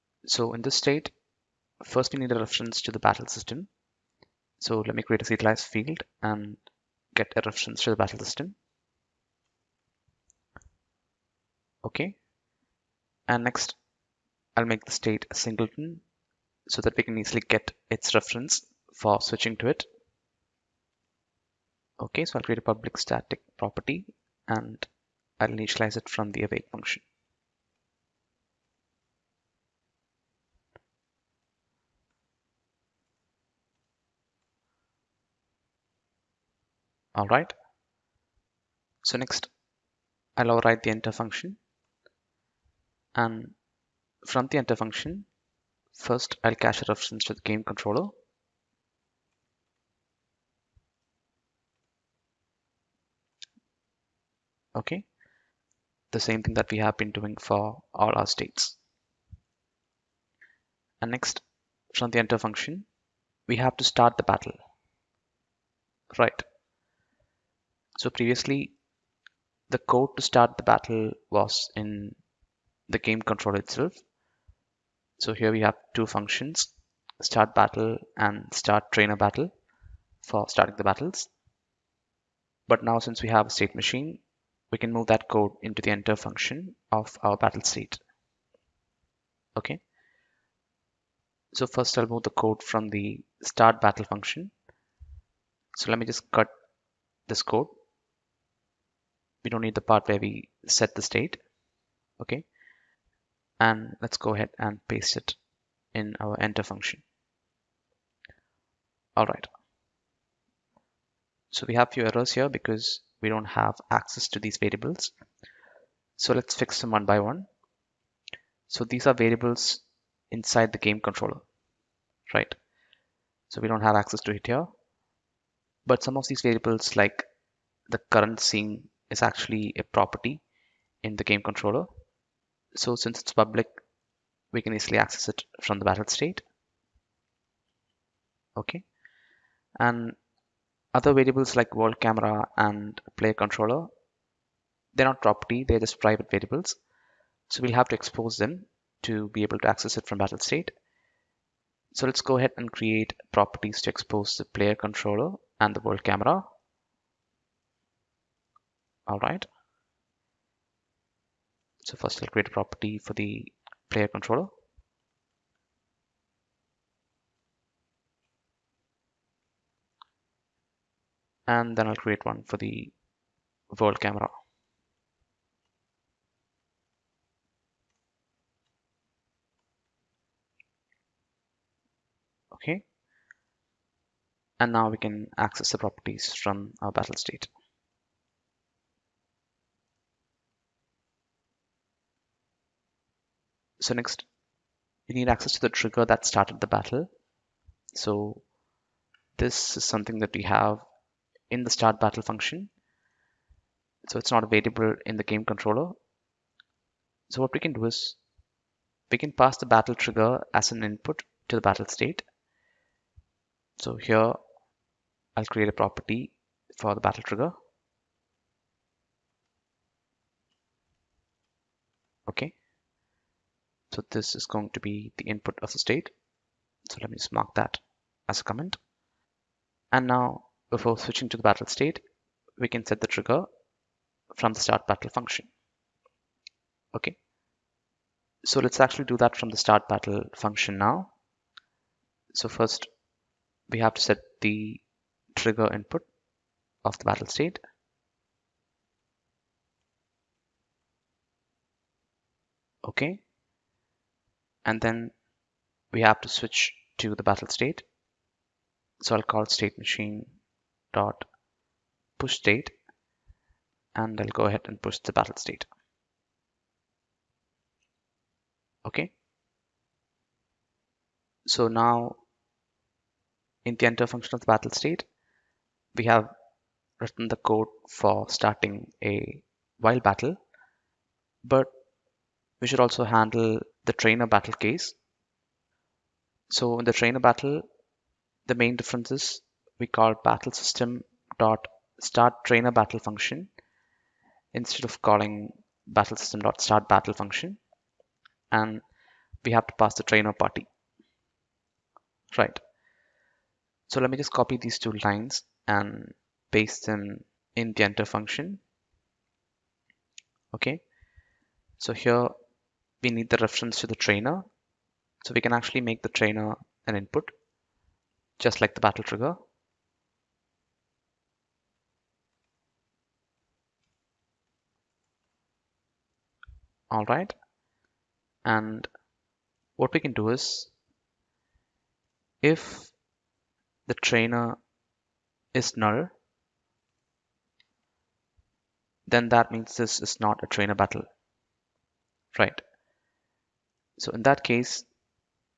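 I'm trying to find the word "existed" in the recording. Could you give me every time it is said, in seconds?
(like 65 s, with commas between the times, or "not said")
not said.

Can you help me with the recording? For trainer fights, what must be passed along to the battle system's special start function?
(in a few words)
the trainer party.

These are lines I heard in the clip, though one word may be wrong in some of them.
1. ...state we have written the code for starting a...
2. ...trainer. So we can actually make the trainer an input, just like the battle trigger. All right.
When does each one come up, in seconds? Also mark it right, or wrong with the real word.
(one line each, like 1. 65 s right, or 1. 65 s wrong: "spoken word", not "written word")
1. 274 s right
2. 313 s right.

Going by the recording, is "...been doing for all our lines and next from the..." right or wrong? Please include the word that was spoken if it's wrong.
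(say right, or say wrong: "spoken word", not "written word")
wrong: "states", not "lines".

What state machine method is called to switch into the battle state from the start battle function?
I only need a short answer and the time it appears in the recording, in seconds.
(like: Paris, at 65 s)
push state, at 262 s.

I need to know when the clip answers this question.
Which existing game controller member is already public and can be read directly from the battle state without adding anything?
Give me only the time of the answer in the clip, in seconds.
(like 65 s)
128 s.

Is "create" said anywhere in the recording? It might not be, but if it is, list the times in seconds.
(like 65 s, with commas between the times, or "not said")
5 s, 22 s, 152 s, 162 s, 171 s, 215 s.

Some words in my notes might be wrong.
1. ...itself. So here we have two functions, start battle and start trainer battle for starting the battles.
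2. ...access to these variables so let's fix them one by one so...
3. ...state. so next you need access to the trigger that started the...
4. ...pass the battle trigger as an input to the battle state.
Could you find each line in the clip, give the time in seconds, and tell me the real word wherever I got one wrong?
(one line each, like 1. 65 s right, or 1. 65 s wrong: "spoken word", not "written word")
1. 73 s right
2. 113 s right
3. 187 s right
4. 209 s right.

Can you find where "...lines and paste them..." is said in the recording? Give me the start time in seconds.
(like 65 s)
305 s.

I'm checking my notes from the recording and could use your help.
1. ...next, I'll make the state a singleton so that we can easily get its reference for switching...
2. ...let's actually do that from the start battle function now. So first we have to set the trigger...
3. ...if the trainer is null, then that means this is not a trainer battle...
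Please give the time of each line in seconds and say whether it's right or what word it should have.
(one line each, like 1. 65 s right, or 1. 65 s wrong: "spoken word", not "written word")
1. 13 s right
2. 238 s right
3. 332 s right.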